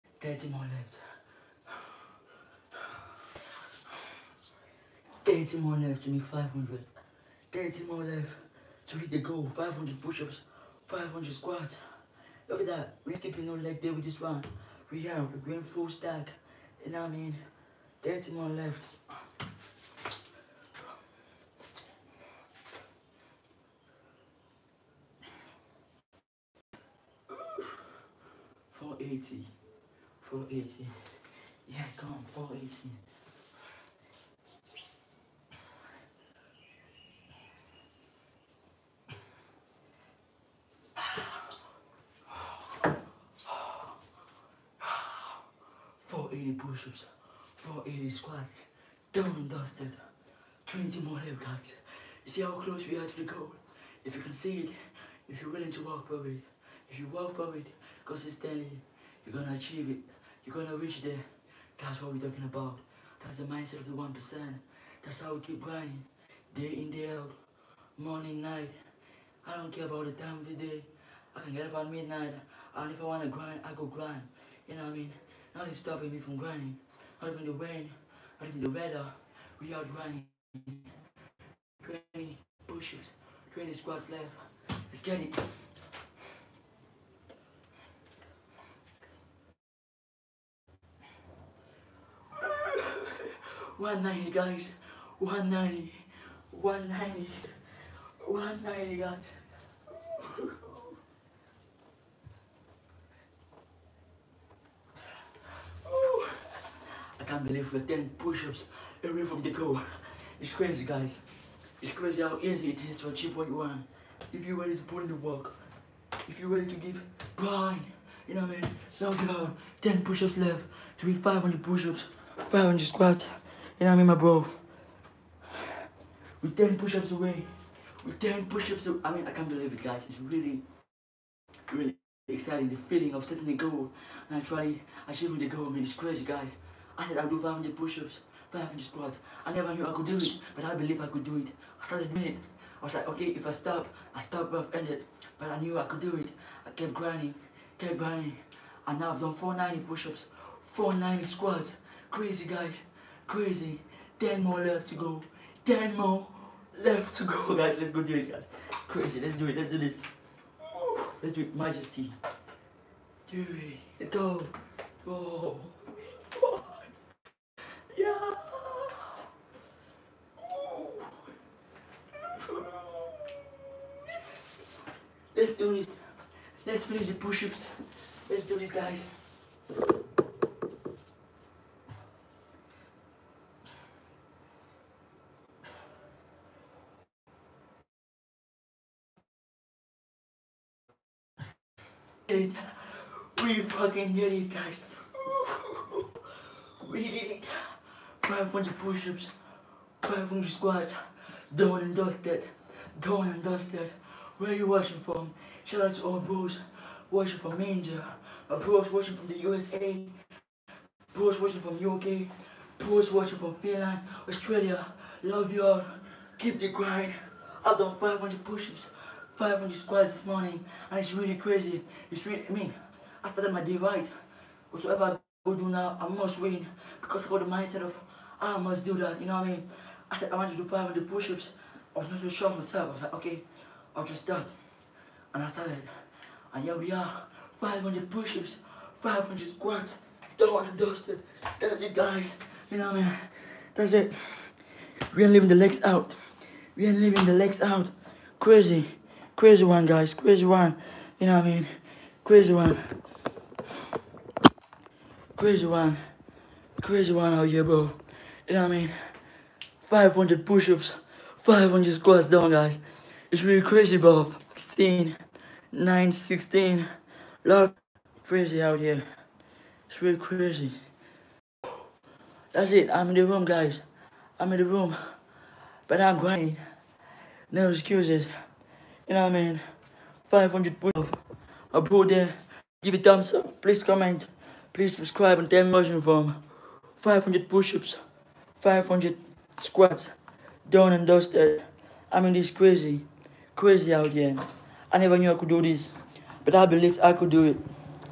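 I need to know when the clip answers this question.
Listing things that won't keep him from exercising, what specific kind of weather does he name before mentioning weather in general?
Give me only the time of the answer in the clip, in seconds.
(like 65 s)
77 s.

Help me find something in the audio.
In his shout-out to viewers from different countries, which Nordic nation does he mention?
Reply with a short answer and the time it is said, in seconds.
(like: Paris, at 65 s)
Finland, at 213 s.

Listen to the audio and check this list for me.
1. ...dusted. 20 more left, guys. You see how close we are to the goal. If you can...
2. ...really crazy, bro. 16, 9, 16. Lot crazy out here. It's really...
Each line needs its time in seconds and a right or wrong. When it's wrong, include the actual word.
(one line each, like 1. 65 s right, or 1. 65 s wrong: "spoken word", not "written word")
1. 49 s right
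2. 263 s right.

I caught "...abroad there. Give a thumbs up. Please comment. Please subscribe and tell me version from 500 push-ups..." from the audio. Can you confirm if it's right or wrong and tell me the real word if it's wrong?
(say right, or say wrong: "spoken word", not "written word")
right.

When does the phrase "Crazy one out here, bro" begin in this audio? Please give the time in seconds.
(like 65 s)
256 s.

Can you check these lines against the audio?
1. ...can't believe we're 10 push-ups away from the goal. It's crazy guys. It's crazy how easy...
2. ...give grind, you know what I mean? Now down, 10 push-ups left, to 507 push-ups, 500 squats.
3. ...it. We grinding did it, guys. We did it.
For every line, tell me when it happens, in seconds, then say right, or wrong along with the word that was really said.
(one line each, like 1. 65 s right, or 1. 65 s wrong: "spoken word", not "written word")
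1. 107 s right
2. 116 s wrong: "500", not "507"
3. 192 s wrong: "fucking", not "grinding".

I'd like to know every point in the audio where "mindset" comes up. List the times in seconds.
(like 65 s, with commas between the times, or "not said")
63 s, 227 s.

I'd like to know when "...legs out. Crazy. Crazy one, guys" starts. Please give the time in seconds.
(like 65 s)
247 s.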